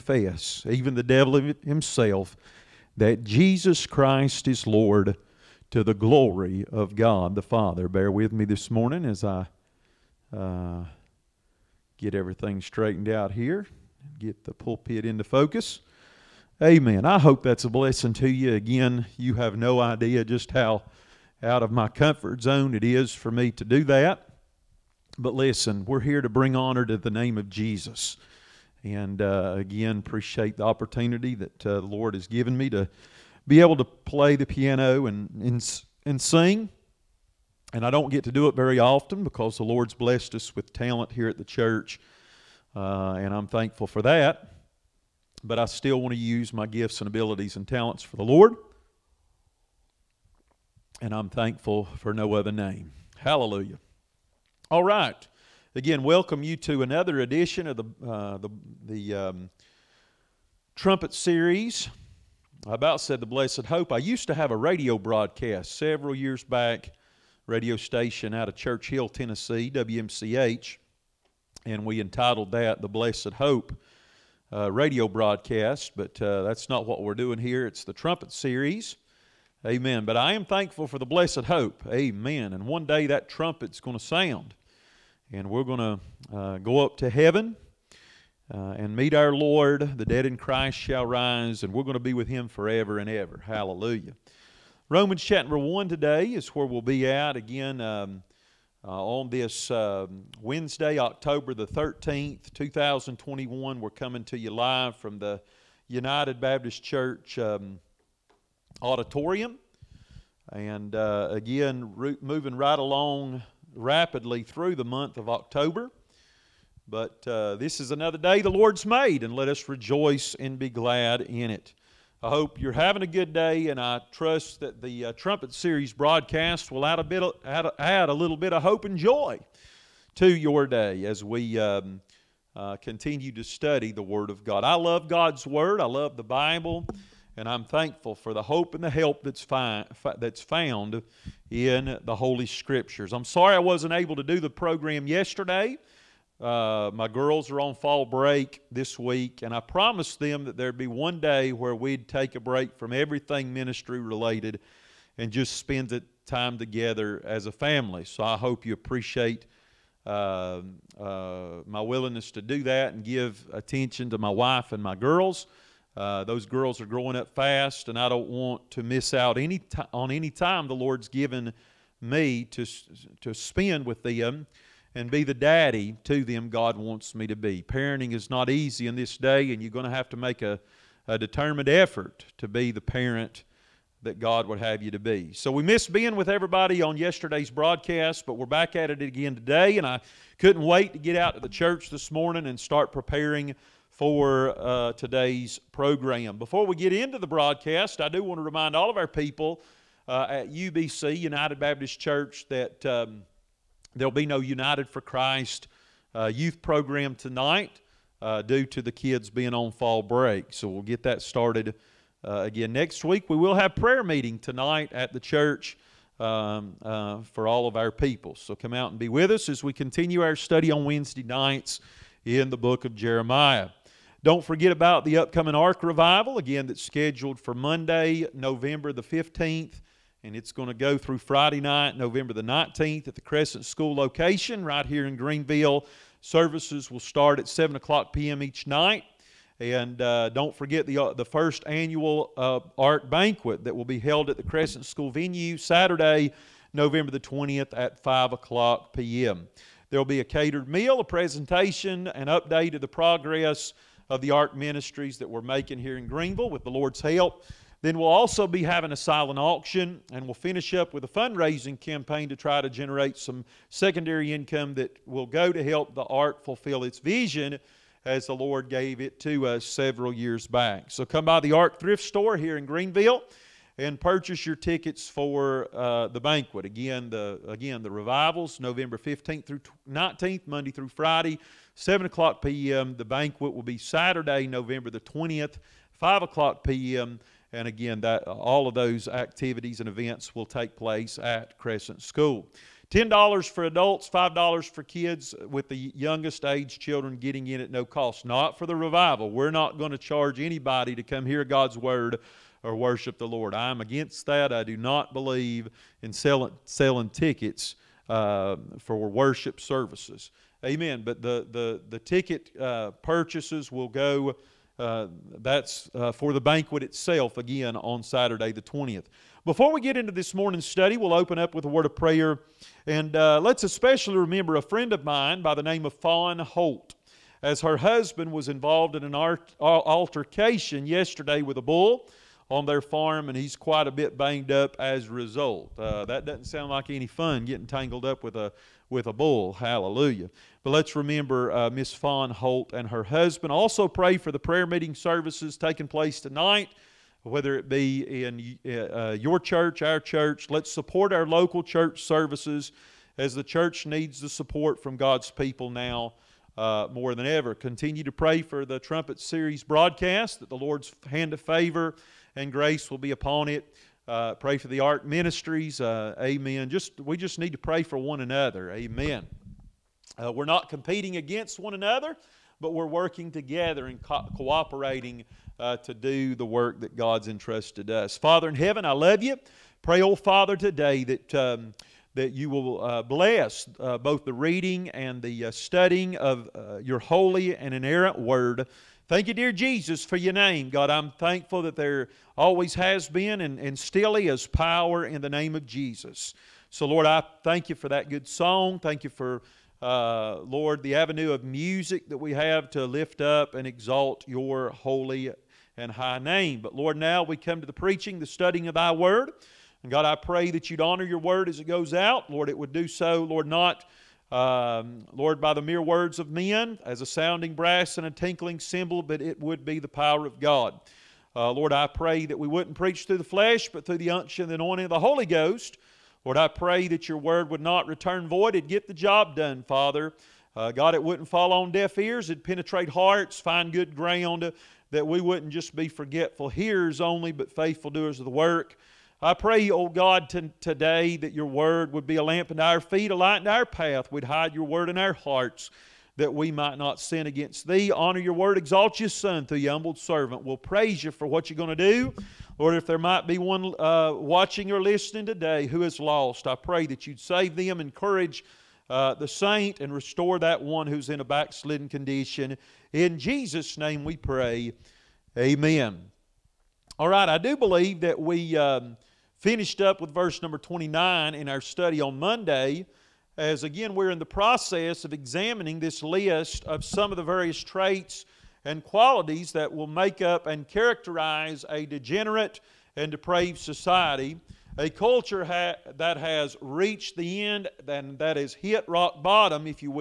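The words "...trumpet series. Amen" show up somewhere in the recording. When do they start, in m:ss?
1:17.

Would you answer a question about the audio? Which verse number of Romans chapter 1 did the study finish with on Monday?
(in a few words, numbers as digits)
29.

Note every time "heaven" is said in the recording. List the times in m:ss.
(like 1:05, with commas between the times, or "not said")
1:27, 6:18.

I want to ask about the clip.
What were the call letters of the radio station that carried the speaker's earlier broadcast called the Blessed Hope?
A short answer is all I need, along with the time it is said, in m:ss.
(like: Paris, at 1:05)
WMCH, at 1:09.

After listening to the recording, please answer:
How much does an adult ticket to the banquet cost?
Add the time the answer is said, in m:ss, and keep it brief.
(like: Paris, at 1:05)
$10, at 4:52.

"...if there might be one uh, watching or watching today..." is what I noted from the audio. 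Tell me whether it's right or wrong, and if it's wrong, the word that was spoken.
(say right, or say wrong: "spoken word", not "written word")
wrong: "listening", not "watching".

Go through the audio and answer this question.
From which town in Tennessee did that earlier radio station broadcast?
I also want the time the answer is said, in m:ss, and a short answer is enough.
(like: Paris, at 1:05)
Church Hill, at 1:08.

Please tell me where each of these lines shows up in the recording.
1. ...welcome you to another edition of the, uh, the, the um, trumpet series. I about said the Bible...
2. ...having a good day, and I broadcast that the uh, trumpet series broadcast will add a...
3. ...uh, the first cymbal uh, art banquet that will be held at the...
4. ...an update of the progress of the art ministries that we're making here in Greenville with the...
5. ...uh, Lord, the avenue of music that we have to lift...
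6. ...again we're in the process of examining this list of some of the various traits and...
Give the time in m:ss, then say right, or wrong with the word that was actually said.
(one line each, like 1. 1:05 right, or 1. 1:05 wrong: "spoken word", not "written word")
1. 0:56 wrong: "Blessed", not "Bible"
2. 2:02 wrong: "trust", not "broadcast"
3. 4:00 wrong: "annual", not "cymbal"
4. 4:12 right
5. 6:39 right
6. 7:53 right.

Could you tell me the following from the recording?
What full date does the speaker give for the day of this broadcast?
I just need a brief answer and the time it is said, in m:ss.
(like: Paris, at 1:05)
October 13, 2021, at 1:40.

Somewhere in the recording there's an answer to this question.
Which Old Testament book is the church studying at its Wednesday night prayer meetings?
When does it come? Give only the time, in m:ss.
3:42.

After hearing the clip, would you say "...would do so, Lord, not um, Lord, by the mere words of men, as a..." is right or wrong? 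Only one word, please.
right.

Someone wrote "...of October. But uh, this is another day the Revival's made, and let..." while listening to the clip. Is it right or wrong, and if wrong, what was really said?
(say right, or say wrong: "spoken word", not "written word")
wrong: "Lord", not "Revival".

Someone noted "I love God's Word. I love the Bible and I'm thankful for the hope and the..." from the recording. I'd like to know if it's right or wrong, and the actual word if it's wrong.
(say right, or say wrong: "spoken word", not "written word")
right.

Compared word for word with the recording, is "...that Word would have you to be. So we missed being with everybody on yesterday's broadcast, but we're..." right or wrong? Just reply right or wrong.
wrong.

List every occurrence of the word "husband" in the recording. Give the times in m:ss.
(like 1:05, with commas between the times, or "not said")
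5:27, 5:43.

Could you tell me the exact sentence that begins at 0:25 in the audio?
But listen, we're here to bring honor to the name of Jesus.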